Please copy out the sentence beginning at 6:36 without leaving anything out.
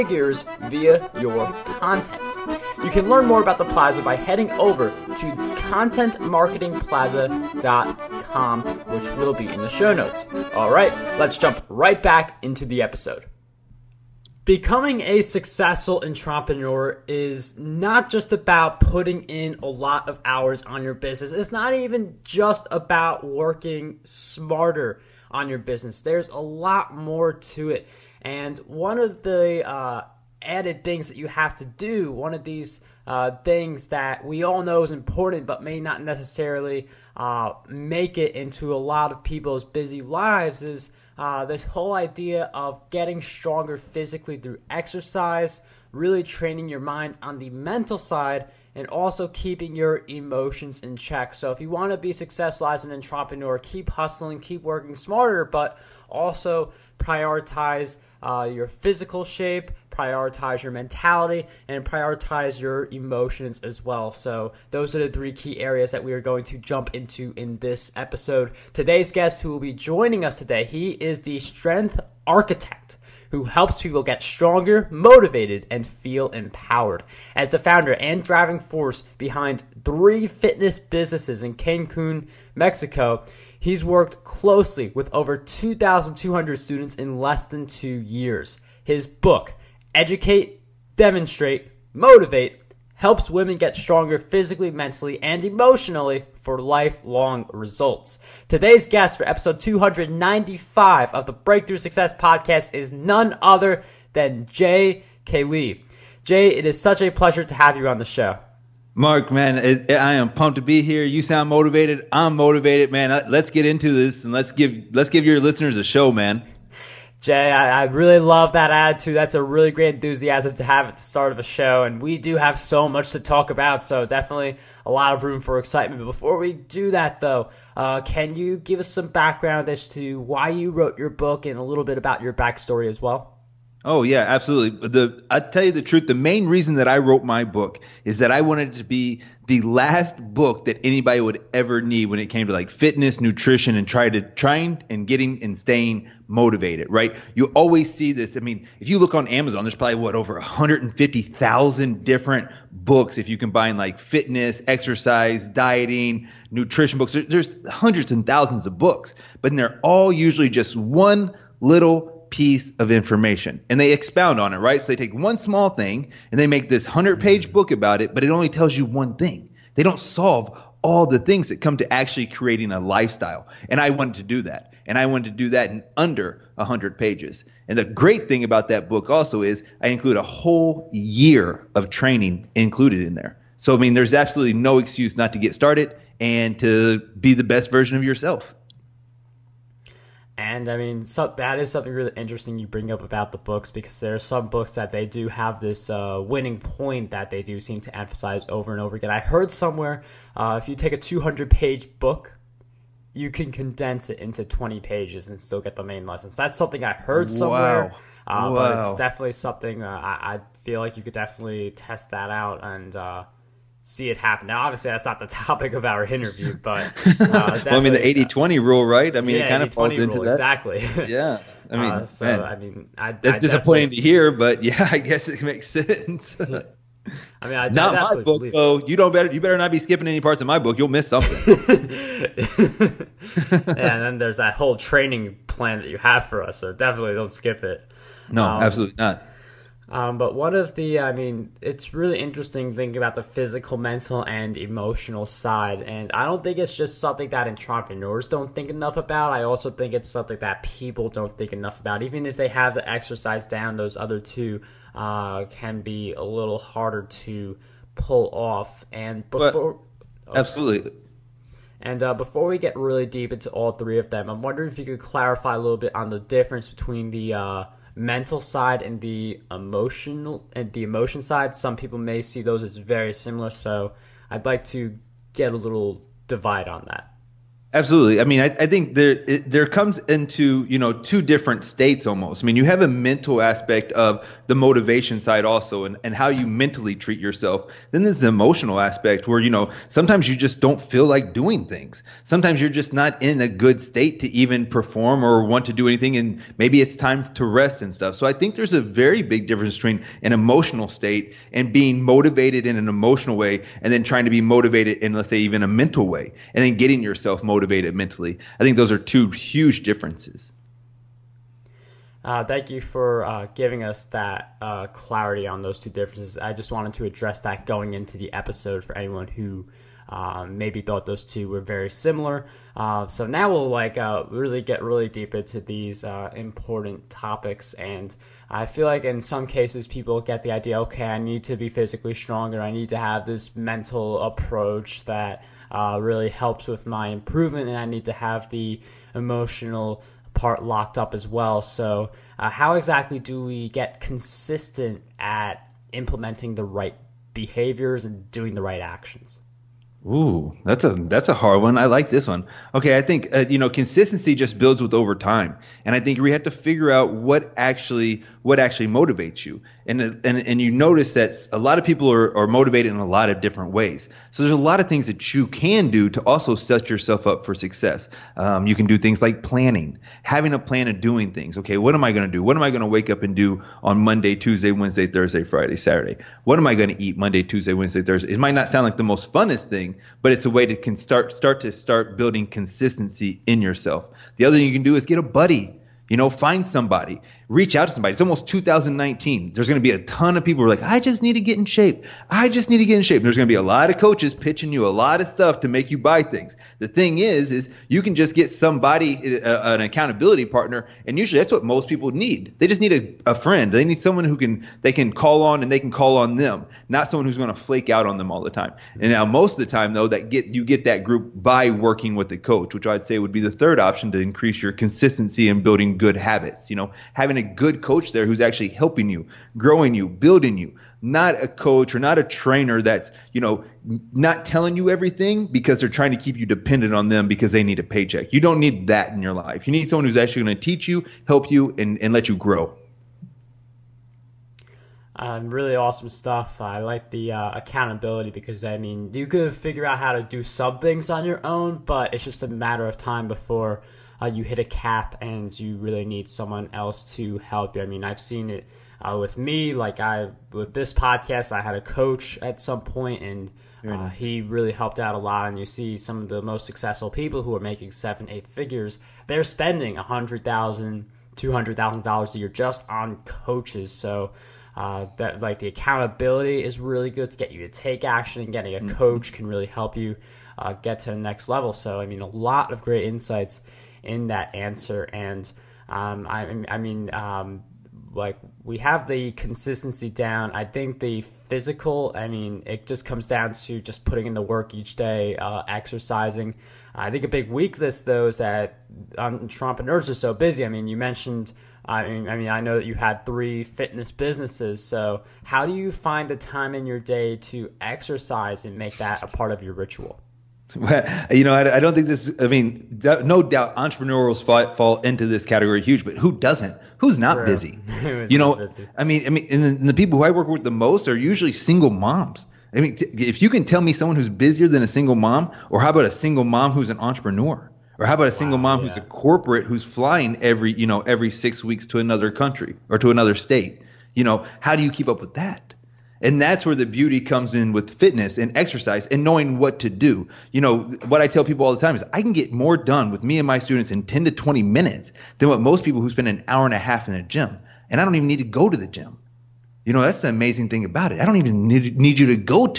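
The thing is, is you can just get somebody, uh, uh, an accountability partner.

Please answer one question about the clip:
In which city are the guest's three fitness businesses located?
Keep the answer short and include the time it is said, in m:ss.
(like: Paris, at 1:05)
Cancun, at 1:21.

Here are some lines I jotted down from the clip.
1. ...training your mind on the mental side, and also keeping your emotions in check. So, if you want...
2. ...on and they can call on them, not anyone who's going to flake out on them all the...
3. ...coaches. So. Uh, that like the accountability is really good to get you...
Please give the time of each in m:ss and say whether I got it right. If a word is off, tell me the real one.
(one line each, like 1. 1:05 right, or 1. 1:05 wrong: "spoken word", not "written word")
1. 0:46 right
2. 6:45 wrong: "someone", not "anyone"
3. 7:43 right.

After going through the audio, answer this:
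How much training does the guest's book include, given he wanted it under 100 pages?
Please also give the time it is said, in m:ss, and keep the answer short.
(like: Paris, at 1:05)
a whole year, at 3:00.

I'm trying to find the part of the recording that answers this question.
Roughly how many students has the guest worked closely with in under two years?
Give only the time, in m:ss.
1:25.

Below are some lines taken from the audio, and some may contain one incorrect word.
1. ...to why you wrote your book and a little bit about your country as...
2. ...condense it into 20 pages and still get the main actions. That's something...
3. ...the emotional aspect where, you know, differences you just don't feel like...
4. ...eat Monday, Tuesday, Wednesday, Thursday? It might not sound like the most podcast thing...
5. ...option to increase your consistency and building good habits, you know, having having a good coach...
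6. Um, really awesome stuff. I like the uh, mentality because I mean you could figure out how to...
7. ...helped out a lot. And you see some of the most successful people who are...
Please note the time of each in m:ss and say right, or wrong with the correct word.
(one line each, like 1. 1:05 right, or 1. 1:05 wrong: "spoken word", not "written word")
1. 2:09 wrong: "backstory", not "country"
2. 3:23 wrong: "lessons", not "actions"
3. 4:48 wrong: "sometimes", not "differences"
4. 6:17 wrong: "funnest", not "podcast"
5. 6:53 right
6. 7:15 wrong: "accountability", not "mentality"
7. 7:34 right.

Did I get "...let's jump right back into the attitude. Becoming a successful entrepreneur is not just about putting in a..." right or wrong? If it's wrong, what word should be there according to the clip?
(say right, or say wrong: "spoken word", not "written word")
wrong: "episode", not "attitude".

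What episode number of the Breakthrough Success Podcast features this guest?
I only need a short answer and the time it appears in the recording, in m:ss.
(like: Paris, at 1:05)
295, at 1:39.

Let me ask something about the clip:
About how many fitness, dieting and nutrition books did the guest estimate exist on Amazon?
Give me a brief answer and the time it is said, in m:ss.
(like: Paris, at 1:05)
150,000, at 2:30.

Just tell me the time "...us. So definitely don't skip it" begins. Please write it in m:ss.
3:56.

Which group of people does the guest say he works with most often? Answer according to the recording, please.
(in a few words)
single moms.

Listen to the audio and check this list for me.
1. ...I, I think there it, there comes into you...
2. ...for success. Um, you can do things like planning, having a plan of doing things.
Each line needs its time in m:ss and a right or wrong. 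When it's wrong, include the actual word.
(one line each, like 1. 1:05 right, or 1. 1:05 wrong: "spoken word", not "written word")
1. 4:38 right
2. 6:07 right.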